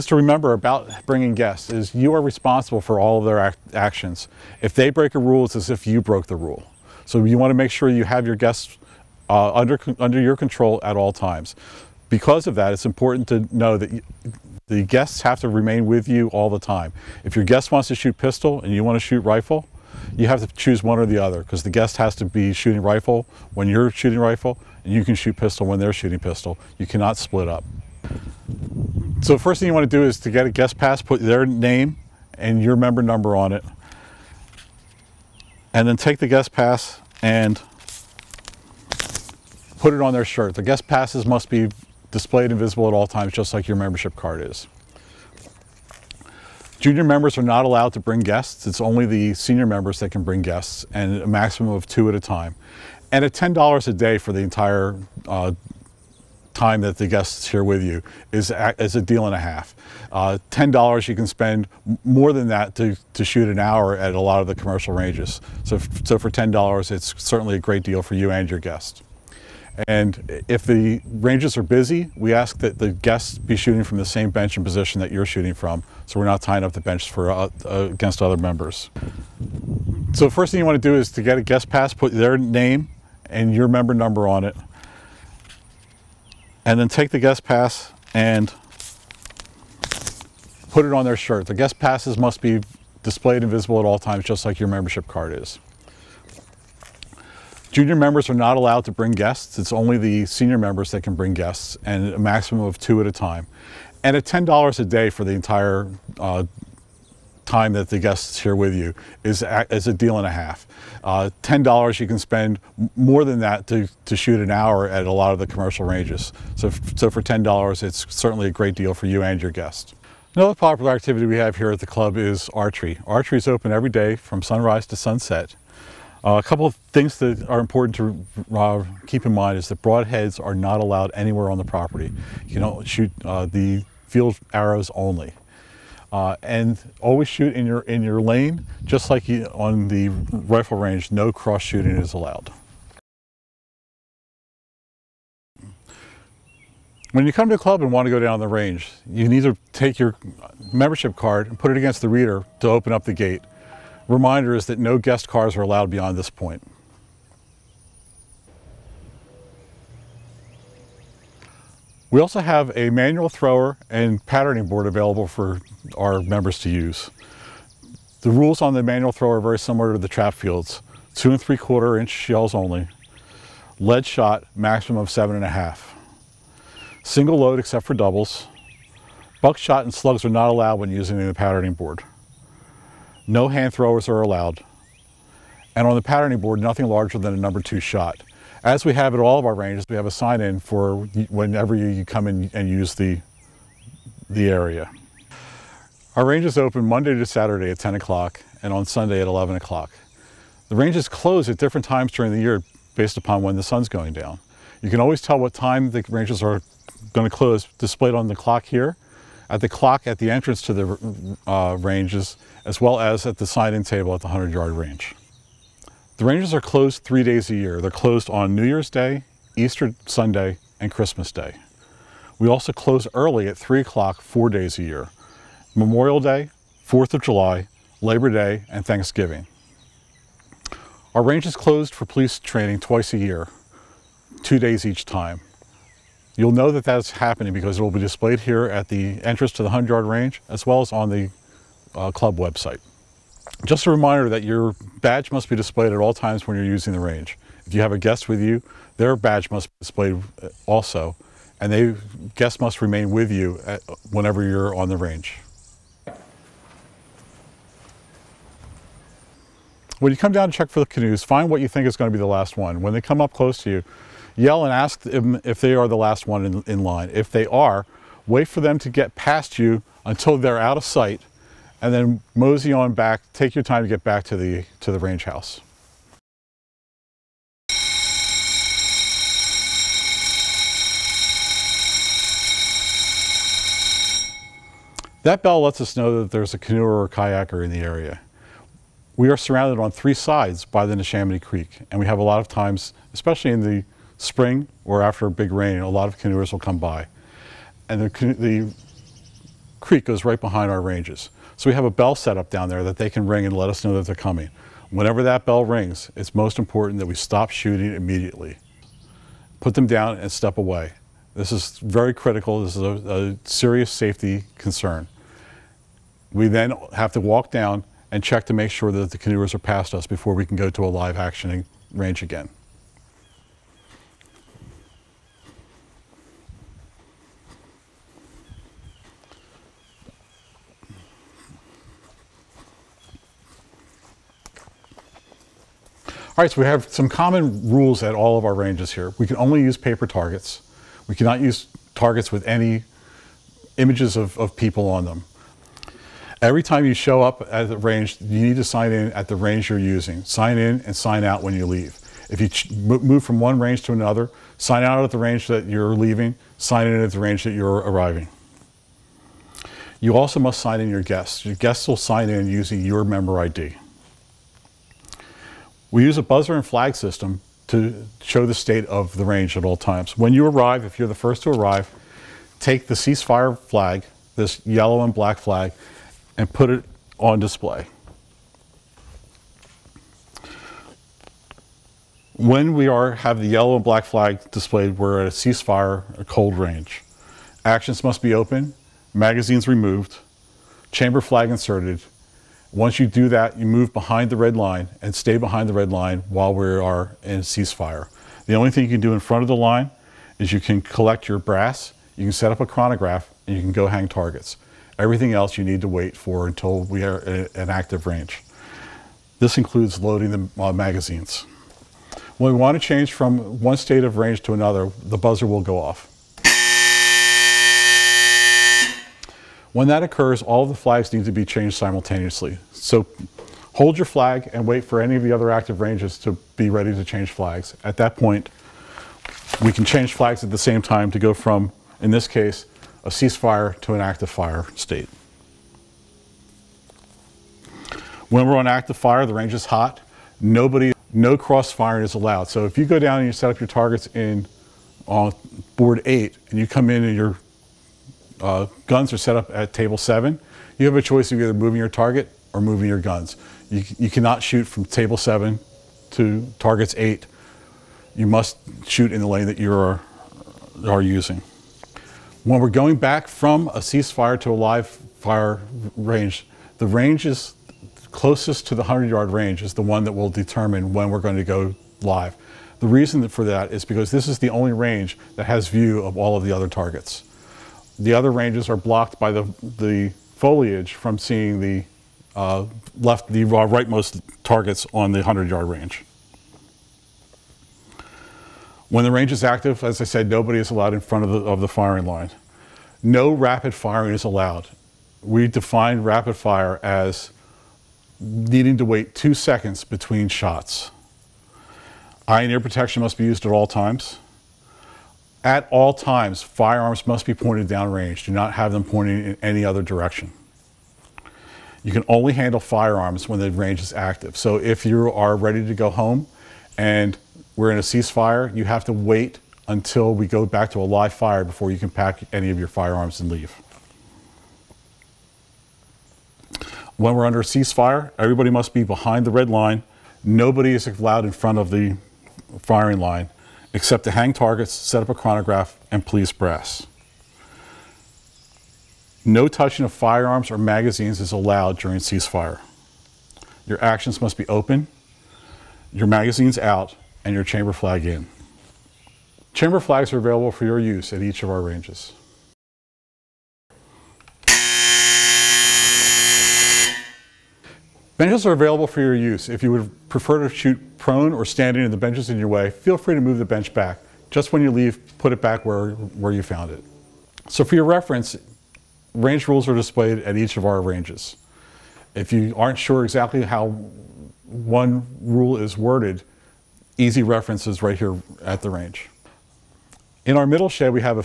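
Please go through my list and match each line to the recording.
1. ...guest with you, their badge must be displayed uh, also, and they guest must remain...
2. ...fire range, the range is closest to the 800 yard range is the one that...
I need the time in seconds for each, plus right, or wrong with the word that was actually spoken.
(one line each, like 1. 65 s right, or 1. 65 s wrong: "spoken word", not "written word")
1. 247 s right
2. 464 s wrong: "100", not "800".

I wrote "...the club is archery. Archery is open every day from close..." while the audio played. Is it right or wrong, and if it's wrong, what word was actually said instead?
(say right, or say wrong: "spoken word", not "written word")
wrong: "sunrise", not "close".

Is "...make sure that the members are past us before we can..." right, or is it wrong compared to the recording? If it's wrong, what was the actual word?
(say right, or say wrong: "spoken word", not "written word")
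wrong: "canoers", not "members".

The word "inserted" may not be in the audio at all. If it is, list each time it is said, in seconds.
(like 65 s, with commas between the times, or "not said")
391 s.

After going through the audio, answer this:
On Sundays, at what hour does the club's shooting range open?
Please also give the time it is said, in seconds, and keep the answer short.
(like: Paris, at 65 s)
11 o'clock, at 199 s.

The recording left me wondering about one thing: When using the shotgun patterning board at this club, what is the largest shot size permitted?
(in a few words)
number 2 shot.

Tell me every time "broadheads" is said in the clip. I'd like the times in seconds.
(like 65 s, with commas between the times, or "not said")
129 s.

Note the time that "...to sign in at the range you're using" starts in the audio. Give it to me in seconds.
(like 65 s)
348 s.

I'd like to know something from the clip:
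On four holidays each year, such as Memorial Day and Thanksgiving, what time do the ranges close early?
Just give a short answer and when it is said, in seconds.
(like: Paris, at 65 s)
3 o'clock, at 223 s.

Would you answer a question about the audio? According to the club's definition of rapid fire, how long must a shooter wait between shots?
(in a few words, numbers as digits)
2 seconds.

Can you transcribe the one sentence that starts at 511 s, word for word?
You can only handle firearms when the range is active.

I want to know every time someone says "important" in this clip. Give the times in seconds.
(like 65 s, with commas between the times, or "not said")
12 s, 127 s, 306 s.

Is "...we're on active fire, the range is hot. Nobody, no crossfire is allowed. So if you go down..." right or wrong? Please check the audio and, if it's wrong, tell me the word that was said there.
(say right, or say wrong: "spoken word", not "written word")
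right.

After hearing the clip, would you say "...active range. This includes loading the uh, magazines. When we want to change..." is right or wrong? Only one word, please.
right.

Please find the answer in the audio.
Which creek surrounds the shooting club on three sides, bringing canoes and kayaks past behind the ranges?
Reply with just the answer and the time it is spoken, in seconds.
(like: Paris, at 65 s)
Neshaminy Creek, at 290 s.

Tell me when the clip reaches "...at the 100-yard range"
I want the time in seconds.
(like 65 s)
214 s.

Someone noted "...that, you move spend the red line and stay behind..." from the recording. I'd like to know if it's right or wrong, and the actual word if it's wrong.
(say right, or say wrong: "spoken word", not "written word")
wrong: "behind", not "spend".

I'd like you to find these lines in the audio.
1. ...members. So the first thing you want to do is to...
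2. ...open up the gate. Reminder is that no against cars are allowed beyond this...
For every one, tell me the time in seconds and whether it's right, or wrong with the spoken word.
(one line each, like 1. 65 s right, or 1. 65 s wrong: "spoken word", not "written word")
1. 78 s right
2. 152 s wrong: "guest", not "against".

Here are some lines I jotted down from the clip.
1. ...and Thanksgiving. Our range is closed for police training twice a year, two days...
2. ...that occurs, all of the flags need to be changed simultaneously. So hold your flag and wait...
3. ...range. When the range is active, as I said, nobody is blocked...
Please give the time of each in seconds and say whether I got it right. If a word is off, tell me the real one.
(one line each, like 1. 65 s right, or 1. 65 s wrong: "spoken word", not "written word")
1. 228 s right
2. 419 s right
3. 485 s wrong: "allowed", not "blocked".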